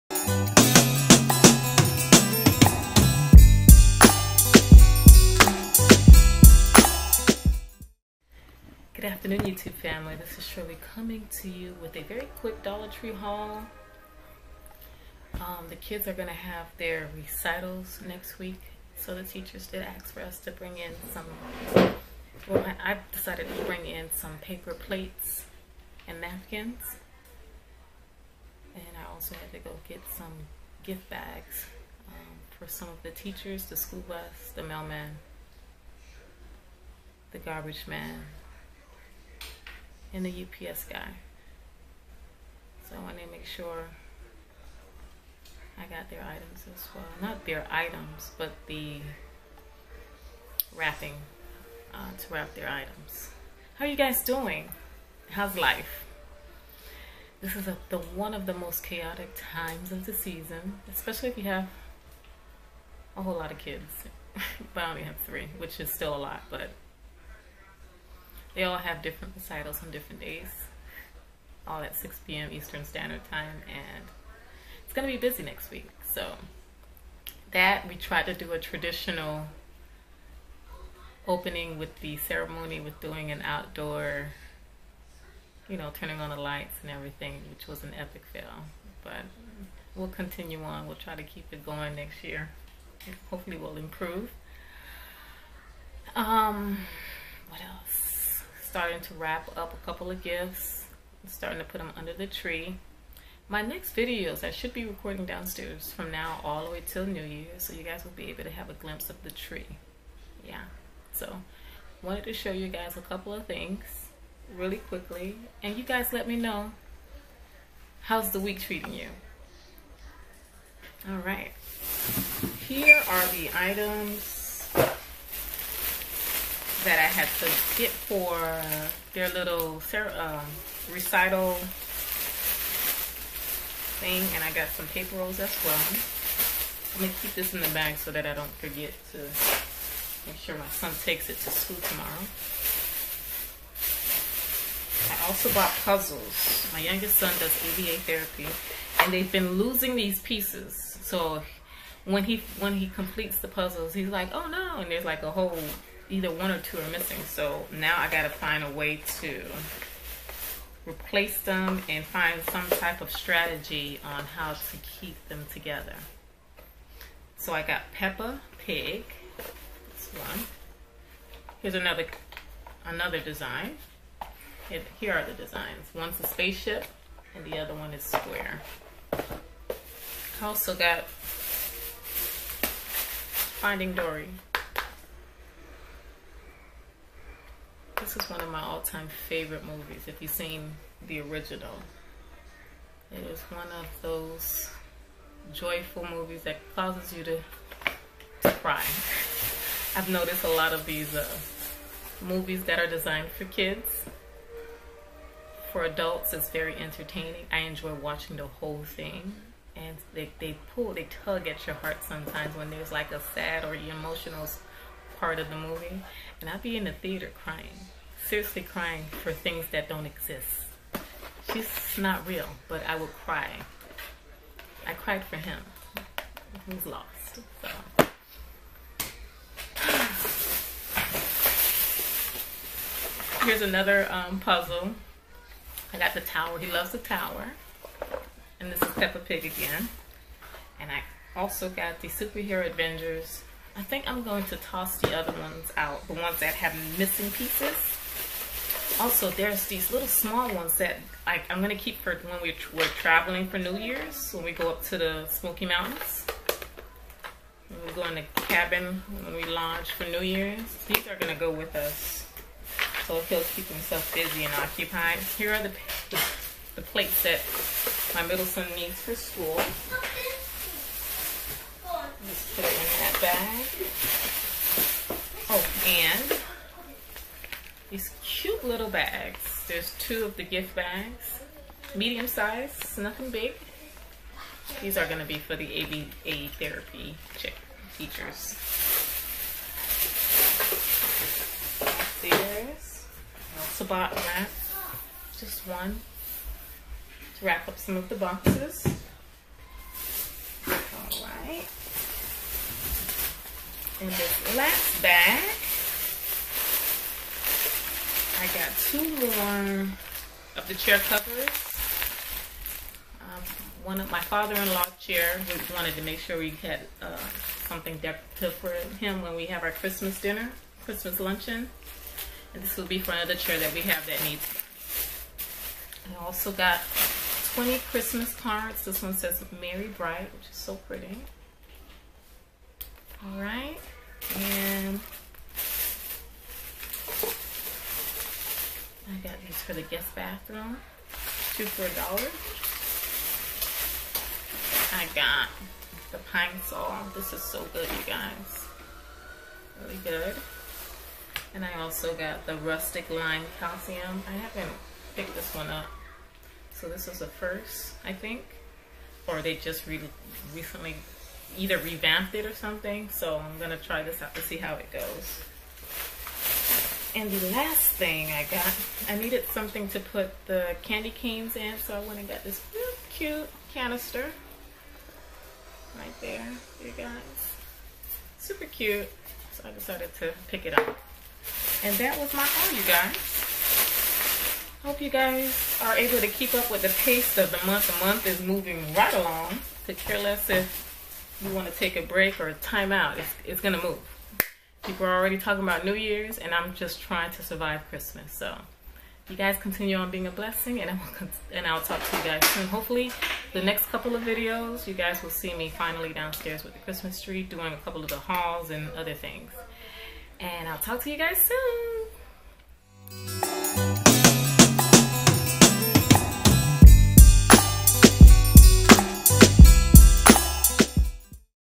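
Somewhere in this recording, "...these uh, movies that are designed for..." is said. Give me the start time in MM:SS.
03:20.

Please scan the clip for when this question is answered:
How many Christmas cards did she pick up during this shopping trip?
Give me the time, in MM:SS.
05:27.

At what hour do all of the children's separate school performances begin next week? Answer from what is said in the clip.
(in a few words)
6 p.m.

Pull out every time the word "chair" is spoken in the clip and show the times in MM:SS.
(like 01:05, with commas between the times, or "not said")
05:10, 05:14, 05:23.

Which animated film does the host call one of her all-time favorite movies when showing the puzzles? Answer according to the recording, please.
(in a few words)
Finding Dory.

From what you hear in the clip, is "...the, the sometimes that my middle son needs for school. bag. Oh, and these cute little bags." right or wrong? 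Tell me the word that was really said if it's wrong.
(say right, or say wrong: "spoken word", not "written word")
wrong: "plates", not "sometimes".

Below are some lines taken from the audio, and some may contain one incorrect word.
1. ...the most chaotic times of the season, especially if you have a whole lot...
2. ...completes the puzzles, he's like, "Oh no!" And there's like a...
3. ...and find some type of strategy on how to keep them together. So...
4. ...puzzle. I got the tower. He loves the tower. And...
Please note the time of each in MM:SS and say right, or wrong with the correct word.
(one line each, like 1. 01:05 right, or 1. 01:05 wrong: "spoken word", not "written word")
1. 00:58 right
2. 02:32 right
3. 02:41 right
4. 03:54 right.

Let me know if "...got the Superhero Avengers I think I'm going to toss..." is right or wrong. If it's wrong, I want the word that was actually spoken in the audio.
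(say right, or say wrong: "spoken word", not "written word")
right.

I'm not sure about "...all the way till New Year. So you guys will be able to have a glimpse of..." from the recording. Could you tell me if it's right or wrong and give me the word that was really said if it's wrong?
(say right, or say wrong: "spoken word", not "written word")
right.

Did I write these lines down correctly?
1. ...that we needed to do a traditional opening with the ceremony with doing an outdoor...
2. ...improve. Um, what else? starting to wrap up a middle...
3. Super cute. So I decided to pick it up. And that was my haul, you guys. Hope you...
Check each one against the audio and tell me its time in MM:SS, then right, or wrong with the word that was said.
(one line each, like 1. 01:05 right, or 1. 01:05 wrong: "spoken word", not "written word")
1. 01:17 wrong: "tried", not "needed"
2. 01:33 wrong: "couple", not "middle"
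3. 06:18 right.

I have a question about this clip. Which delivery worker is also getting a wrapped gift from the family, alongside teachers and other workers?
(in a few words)
UPS guy.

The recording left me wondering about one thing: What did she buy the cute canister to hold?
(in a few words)
candy canes.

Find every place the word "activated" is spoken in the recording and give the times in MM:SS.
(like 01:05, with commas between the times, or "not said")
not said.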